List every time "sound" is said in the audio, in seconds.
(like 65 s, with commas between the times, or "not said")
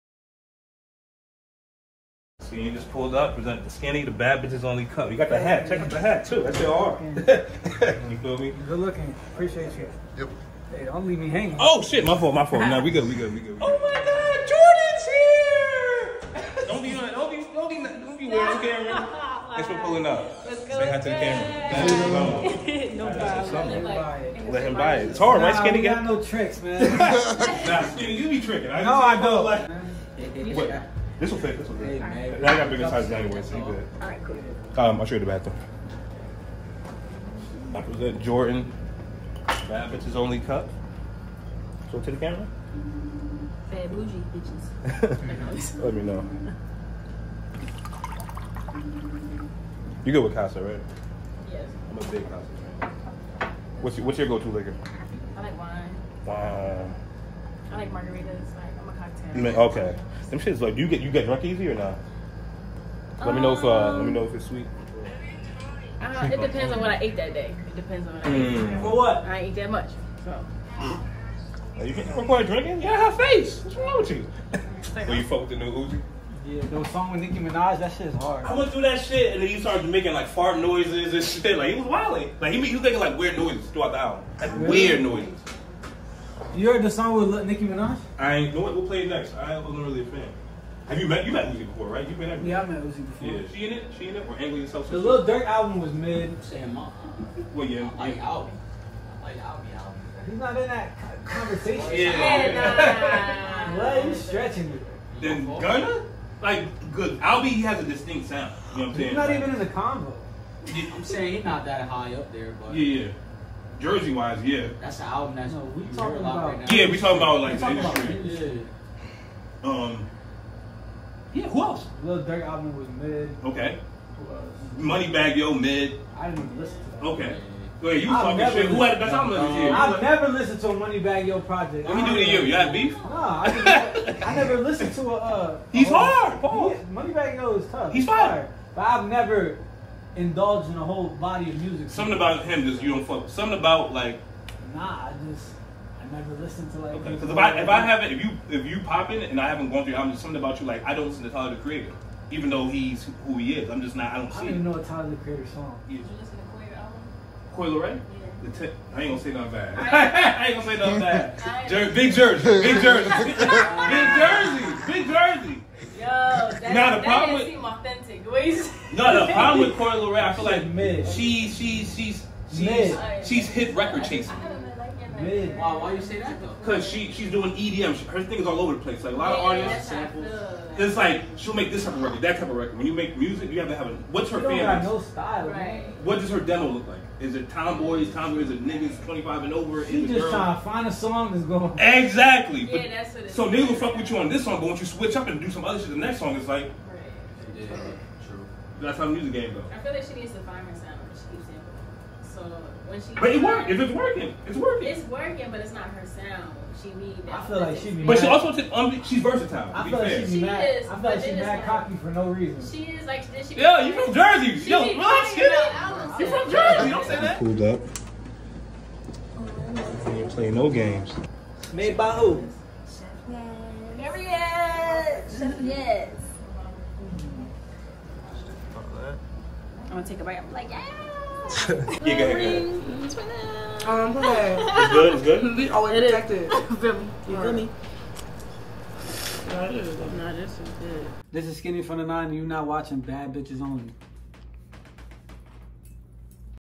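108 s, 200 s, 206 s.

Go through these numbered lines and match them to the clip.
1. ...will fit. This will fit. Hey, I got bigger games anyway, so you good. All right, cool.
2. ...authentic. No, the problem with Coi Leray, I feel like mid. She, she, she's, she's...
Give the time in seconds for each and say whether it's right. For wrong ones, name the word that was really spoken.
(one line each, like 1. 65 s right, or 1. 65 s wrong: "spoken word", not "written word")
1. 31 s wrong: "sizes", not "games"
2. 167 s right.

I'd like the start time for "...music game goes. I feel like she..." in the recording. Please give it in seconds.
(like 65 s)
199 s.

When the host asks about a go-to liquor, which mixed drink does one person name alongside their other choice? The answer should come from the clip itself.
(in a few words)
Margaritas.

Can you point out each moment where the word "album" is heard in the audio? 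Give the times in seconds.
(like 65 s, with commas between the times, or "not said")
83 s, 95 s, 99 s, 115 s, 122 s, 129 s, 157 s.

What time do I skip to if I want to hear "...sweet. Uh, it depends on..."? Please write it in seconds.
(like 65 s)
64 s.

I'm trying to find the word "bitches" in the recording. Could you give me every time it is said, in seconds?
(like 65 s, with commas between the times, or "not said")
4 s, 39 s, 44 s, 243 s.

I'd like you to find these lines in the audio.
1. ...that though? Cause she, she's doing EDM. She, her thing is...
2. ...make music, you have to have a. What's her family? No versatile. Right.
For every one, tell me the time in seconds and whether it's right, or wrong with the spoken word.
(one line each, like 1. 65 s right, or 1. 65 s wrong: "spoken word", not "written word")
1. 176 s right
2. 182 s wrong: "style", not "versatile".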